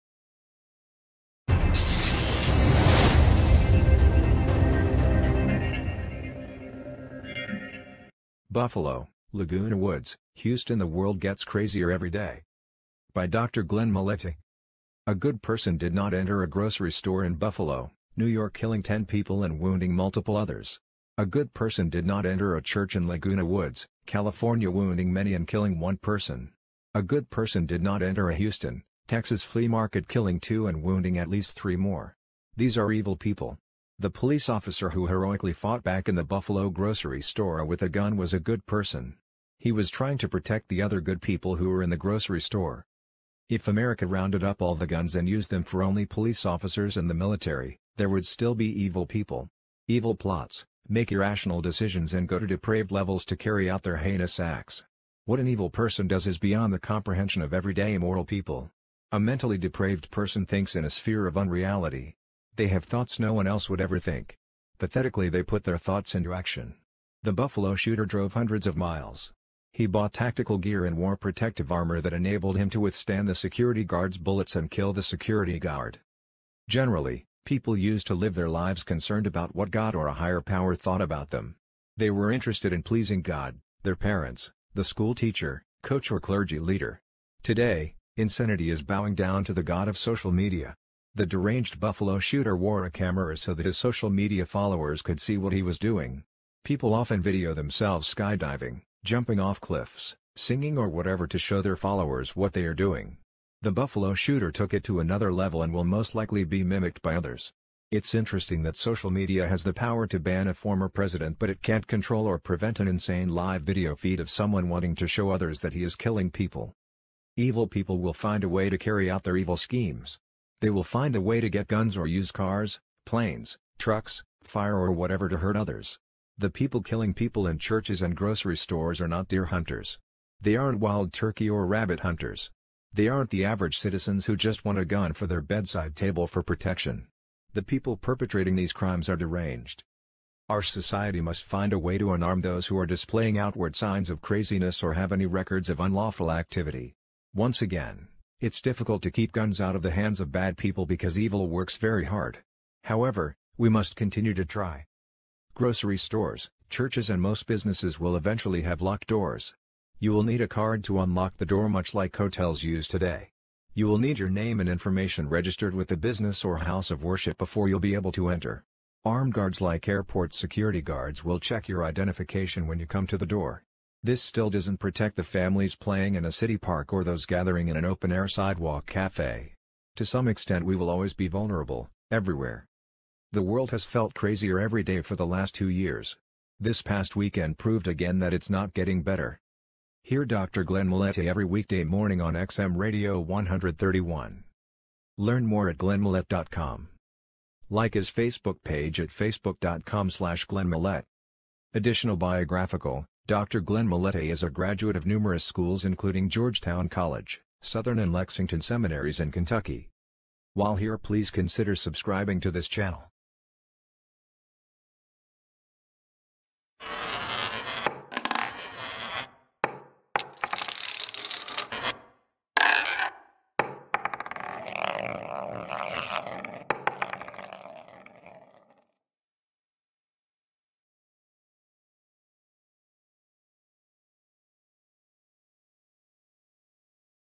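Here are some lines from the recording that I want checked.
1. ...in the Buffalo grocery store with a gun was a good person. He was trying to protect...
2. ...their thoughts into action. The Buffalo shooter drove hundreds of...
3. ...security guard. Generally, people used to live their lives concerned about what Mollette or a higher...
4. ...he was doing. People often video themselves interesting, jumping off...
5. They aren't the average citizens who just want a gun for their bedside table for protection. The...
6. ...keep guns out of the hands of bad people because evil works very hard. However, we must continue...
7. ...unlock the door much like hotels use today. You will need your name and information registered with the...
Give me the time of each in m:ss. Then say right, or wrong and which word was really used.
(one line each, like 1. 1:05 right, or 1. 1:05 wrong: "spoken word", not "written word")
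1. 0:36 right
2. 1:05 right
3. 1:15 wrong: "God", not "Mollette"
4. 1:35 wrong: "skydiving", not "interesting"
5. 2:12 right
6. 2:29 right
7. 2:41 right.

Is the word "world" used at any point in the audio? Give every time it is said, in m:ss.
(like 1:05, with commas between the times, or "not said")
0:10, 3:03.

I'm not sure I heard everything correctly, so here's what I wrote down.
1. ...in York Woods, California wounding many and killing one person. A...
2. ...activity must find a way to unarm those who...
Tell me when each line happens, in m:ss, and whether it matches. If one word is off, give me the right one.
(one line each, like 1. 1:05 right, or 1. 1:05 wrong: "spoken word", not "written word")
1. 0:22 wrong: "Laguna", not "York"
2. 2:20 wrong: "society", not "activity".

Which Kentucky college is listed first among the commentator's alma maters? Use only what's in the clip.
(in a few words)
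Georgetown College.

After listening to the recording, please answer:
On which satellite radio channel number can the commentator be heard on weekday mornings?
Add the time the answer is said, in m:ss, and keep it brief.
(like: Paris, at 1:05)
131, at 3:13.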